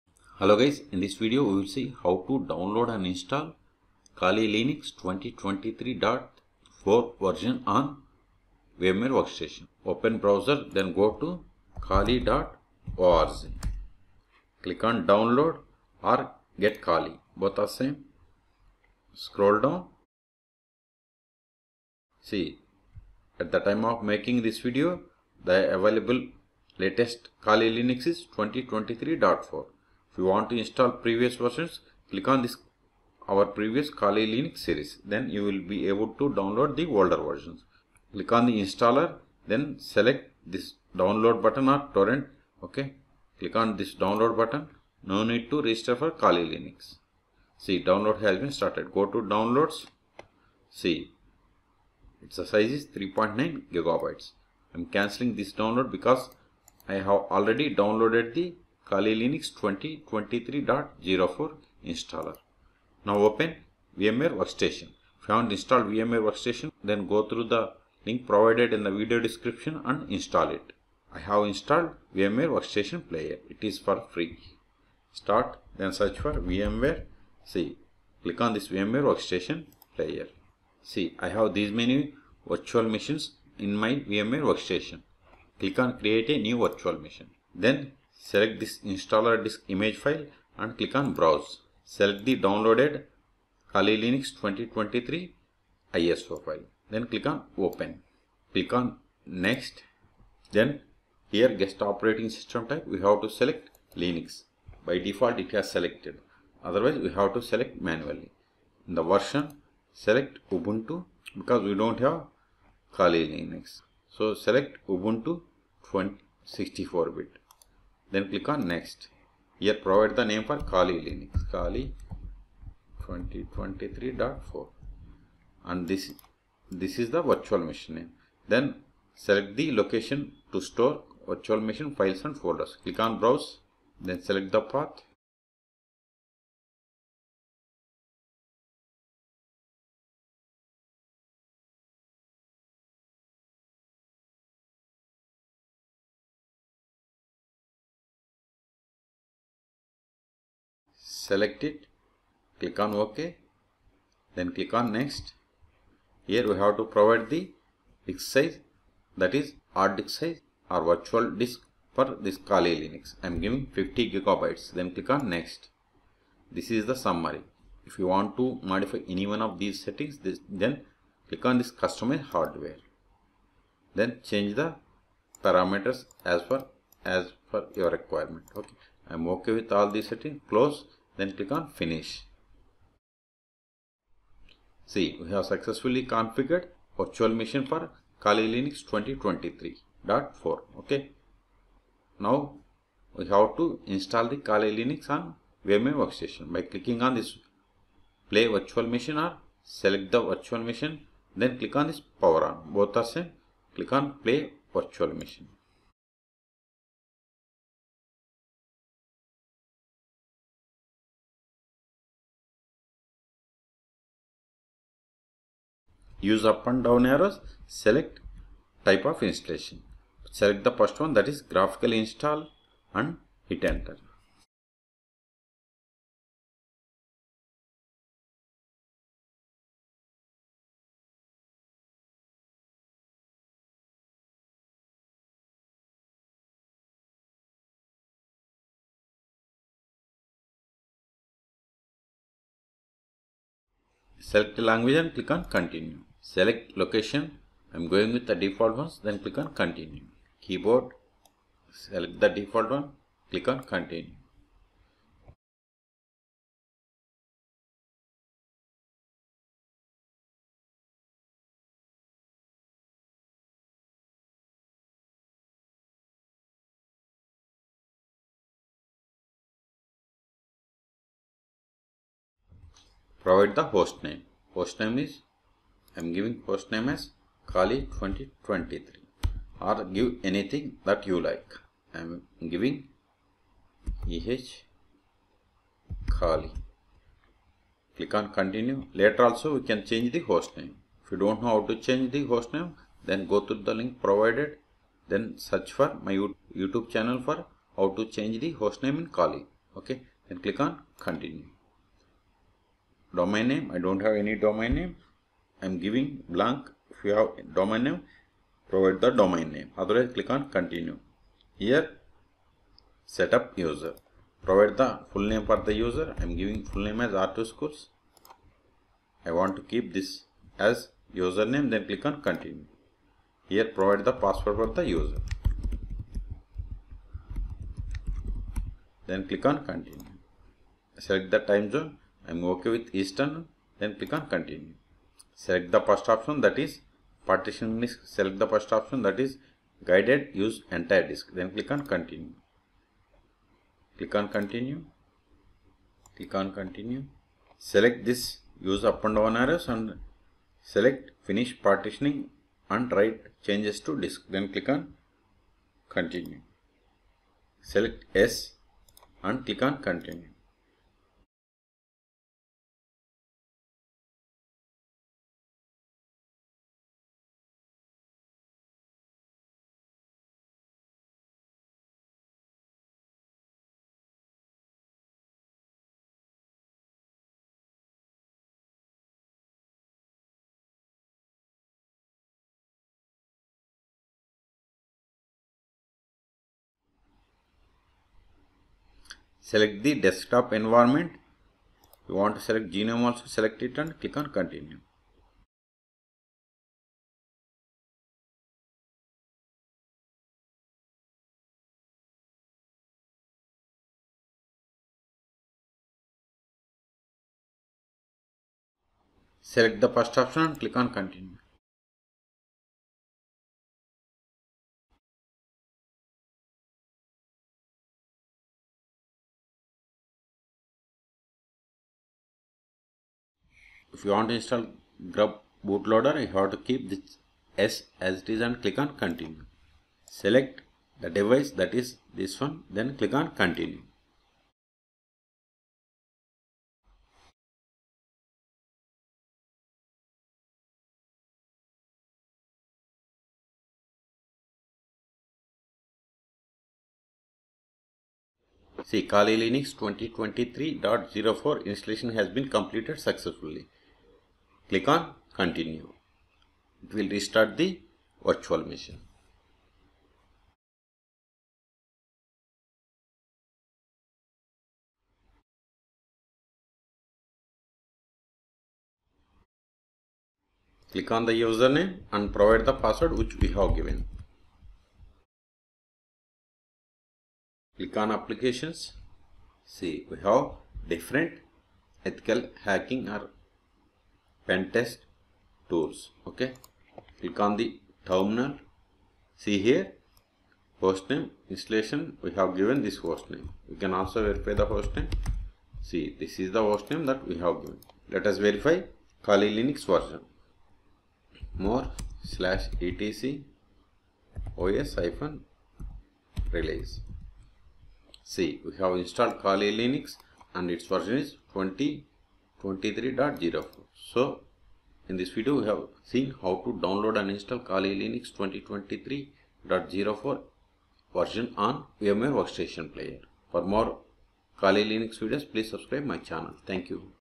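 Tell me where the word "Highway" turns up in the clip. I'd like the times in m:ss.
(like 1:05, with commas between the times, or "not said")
not said.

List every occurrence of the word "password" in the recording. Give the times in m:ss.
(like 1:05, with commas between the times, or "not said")
5:24, 7:52.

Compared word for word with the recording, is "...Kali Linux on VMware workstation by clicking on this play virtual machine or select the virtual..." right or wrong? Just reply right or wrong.
right.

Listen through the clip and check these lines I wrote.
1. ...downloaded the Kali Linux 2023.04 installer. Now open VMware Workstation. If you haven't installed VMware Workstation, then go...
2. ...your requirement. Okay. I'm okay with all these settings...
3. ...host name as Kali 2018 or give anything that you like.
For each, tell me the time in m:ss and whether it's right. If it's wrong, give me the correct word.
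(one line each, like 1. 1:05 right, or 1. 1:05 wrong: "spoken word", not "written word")
1. 0:57 right
2. 2:57 right
3. 4:36 wrong: "2023", not "2018".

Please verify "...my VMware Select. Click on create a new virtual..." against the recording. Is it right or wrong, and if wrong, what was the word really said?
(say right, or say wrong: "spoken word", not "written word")
wrong: "Workstation", not "Select".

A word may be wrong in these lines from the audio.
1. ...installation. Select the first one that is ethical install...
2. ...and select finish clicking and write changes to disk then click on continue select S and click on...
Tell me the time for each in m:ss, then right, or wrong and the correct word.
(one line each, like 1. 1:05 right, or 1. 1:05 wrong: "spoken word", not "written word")
1. 3:39 wrong: "graphical", not "ethical"
2. 5:49 wrong: "partitioning", not "clicking".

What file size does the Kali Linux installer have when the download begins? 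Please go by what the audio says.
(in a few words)
3.9 gigabytes.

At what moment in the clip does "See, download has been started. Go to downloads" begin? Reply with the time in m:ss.
0:47.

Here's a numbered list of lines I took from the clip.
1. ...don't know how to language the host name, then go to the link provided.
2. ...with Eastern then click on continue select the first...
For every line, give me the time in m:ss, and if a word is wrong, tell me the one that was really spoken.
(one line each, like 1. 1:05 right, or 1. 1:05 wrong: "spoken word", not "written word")
1. 4:51 wrong: "change", not "language"
2. 5:32 right.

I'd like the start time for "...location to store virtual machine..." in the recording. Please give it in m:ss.
2:09.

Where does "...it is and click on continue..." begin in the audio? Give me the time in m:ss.
7:08.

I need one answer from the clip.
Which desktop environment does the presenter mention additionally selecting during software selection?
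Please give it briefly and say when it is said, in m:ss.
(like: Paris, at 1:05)
GNOME, at 6:32.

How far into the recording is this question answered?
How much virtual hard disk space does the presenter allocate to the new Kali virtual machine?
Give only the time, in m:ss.
2:43.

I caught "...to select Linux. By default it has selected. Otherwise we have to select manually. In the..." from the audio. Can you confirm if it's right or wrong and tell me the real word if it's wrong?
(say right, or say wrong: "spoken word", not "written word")
right.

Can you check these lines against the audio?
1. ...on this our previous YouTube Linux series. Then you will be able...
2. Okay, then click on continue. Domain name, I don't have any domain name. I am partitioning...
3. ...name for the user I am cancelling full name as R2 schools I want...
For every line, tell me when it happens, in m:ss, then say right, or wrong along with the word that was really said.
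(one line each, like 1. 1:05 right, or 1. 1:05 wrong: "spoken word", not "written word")
1. 0:32 wrong: "Kali", not "YouTube"
2. 4:59 wrong: "giving", not "partitioning"
3. 5:15 wrong: "giving", not "cancelling".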